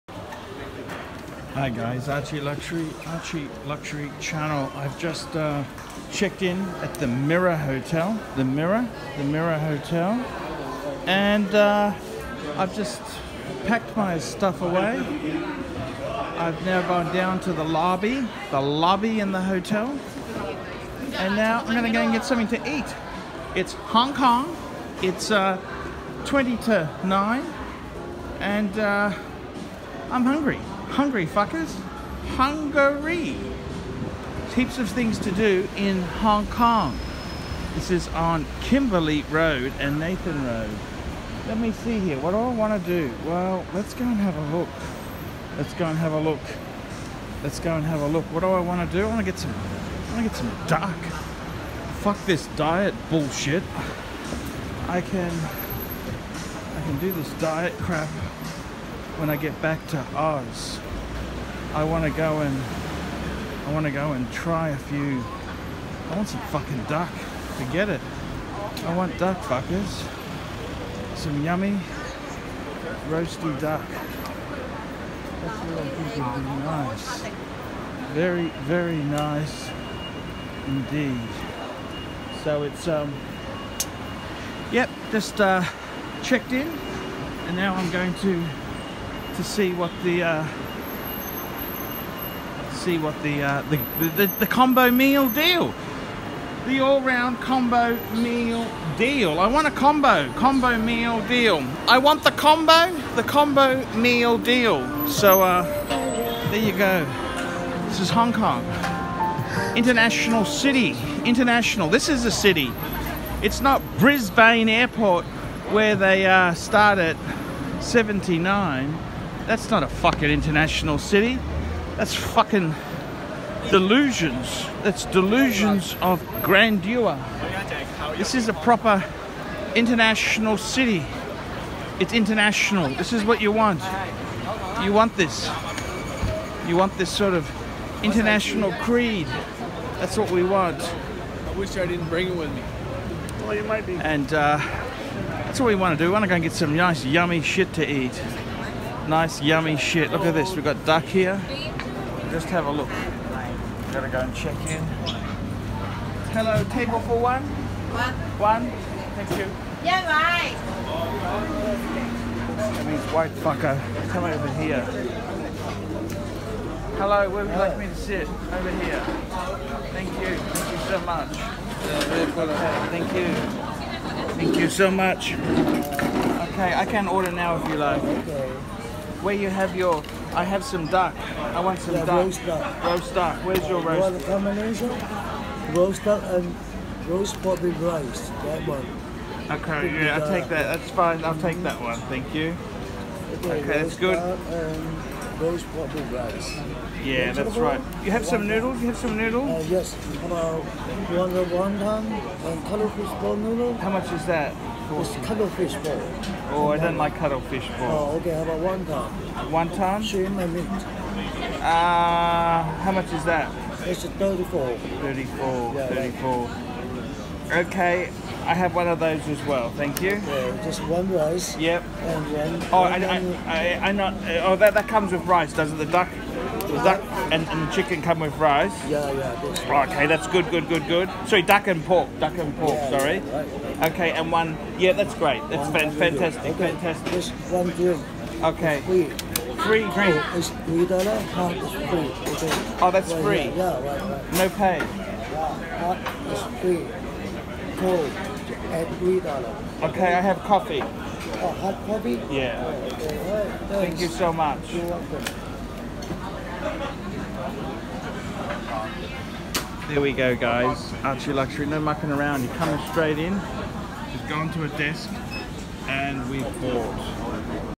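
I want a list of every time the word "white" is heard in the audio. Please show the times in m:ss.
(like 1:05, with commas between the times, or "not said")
2:43.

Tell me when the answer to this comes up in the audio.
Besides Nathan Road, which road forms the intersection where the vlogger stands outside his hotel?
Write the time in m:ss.
0:38.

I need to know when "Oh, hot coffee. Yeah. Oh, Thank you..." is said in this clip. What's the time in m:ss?
4:10.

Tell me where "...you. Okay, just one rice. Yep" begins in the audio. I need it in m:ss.
3:40.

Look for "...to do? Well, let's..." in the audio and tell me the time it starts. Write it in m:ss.
0:42.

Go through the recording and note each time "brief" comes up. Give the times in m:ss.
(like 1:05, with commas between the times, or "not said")
not said.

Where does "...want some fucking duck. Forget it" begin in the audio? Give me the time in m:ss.
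1:06.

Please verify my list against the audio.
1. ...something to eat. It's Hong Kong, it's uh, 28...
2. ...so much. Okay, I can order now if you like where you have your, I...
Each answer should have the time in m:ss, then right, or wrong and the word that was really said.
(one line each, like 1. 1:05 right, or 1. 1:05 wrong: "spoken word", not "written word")
1. 0:22 wrong: "20", not "28"
2. 2:54 right.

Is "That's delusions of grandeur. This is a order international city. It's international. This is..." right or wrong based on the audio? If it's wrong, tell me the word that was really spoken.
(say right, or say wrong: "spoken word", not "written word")
wrong: "proper", not "order".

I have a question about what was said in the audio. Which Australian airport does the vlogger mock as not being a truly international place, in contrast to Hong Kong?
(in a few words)
Brisbane Airport.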